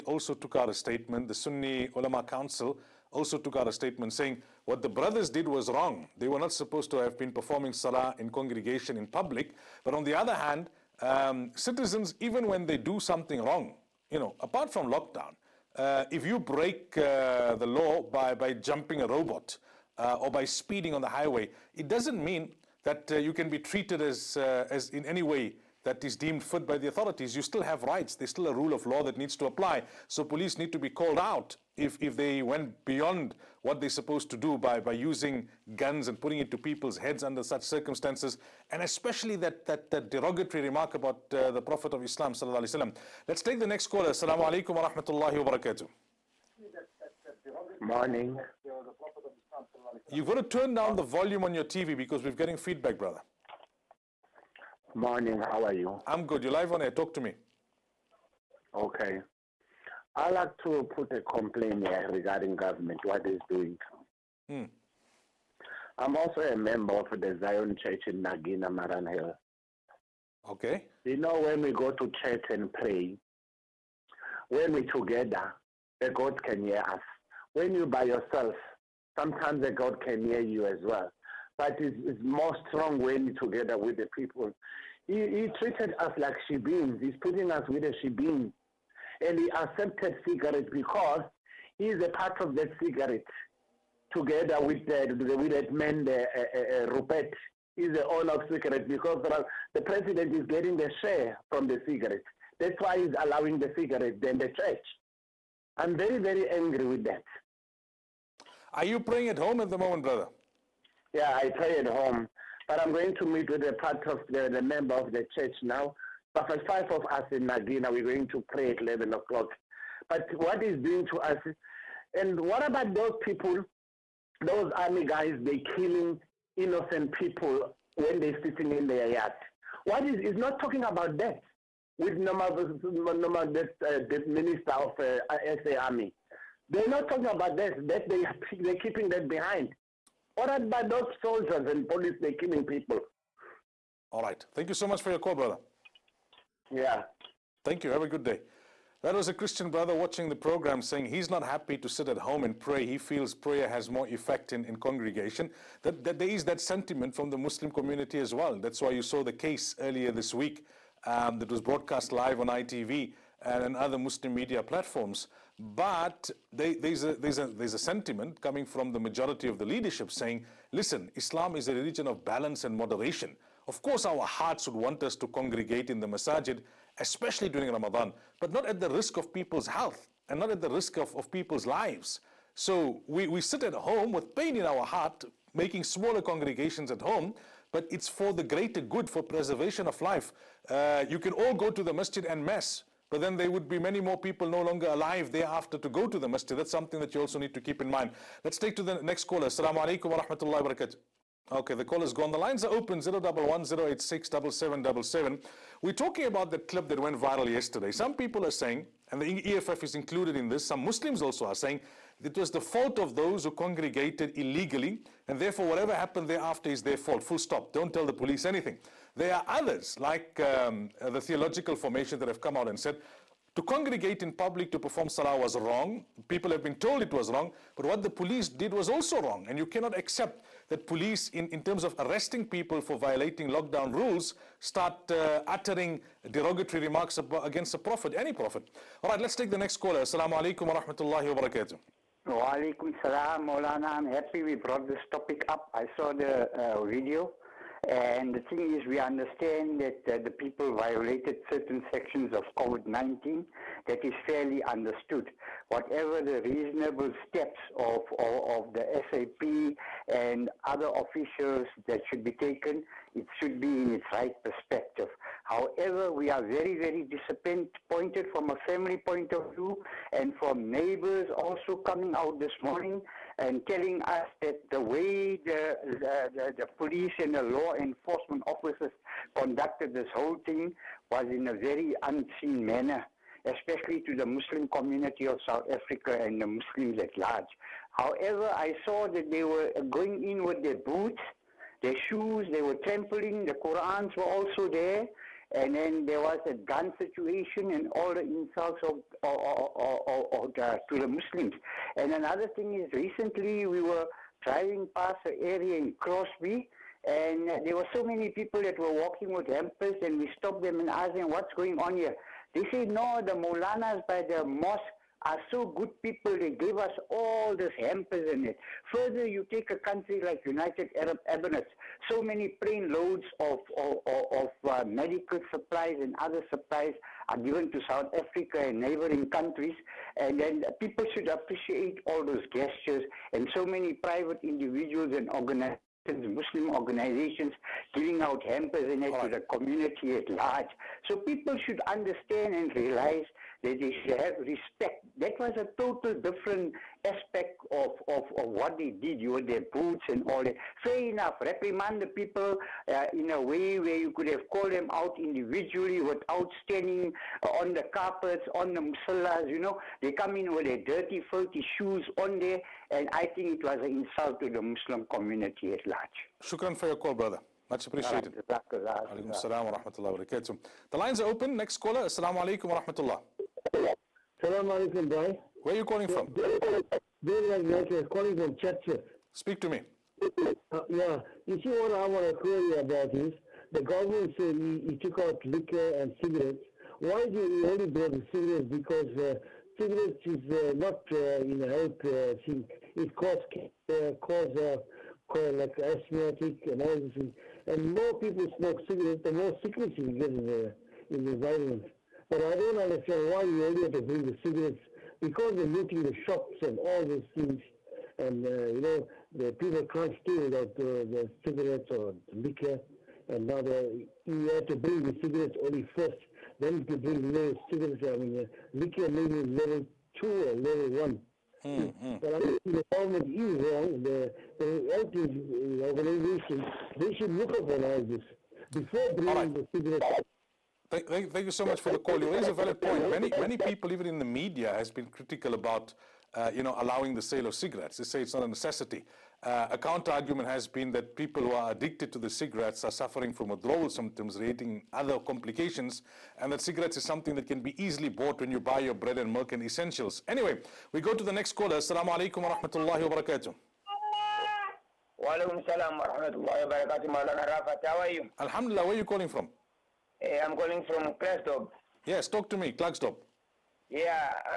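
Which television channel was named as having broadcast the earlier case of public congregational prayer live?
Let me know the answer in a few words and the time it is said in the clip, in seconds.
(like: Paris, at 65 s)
ITV, at 162 s.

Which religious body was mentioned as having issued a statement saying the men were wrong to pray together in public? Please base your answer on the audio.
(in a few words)
Sunni Ulama Council.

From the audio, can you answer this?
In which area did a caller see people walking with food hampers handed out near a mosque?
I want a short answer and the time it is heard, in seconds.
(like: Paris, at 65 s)
Crosby, at 305 s.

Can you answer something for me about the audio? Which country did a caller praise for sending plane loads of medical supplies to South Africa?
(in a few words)
United Arab Emirates.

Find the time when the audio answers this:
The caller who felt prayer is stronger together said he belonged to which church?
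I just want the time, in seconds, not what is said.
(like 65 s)
67 s.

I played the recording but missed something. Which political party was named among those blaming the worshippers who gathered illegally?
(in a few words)
EFF.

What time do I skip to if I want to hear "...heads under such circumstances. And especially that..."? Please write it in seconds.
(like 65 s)
36 s.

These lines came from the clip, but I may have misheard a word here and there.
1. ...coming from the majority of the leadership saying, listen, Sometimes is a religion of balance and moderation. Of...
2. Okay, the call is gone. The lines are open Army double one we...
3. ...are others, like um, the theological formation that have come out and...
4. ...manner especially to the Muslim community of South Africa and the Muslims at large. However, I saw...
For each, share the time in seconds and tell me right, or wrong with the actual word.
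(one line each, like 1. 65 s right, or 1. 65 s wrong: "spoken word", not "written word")
1. 168 s wrong: "Islam", not "Sometimes"
2. 201 s wrong: "Zero", not "Army"
3. 219 s right
4. 282 s right.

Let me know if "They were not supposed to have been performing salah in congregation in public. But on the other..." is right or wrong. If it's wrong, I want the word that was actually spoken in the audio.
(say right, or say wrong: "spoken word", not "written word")
right.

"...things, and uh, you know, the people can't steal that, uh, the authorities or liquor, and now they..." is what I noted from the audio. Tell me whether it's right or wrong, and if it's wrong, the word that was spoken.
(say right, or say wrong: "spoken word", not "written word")
wrong: "cigarettes", not "authorities".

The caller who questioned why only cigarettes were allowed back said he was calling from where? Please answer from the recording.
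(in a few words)
Churchill.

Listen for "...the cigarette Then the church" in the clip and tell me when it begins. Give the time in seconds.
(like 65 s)
103 s.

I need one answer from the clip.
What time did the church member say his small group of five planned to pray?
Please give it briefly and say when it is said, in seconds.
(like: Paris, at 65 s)
11 o'clock, at 118 s.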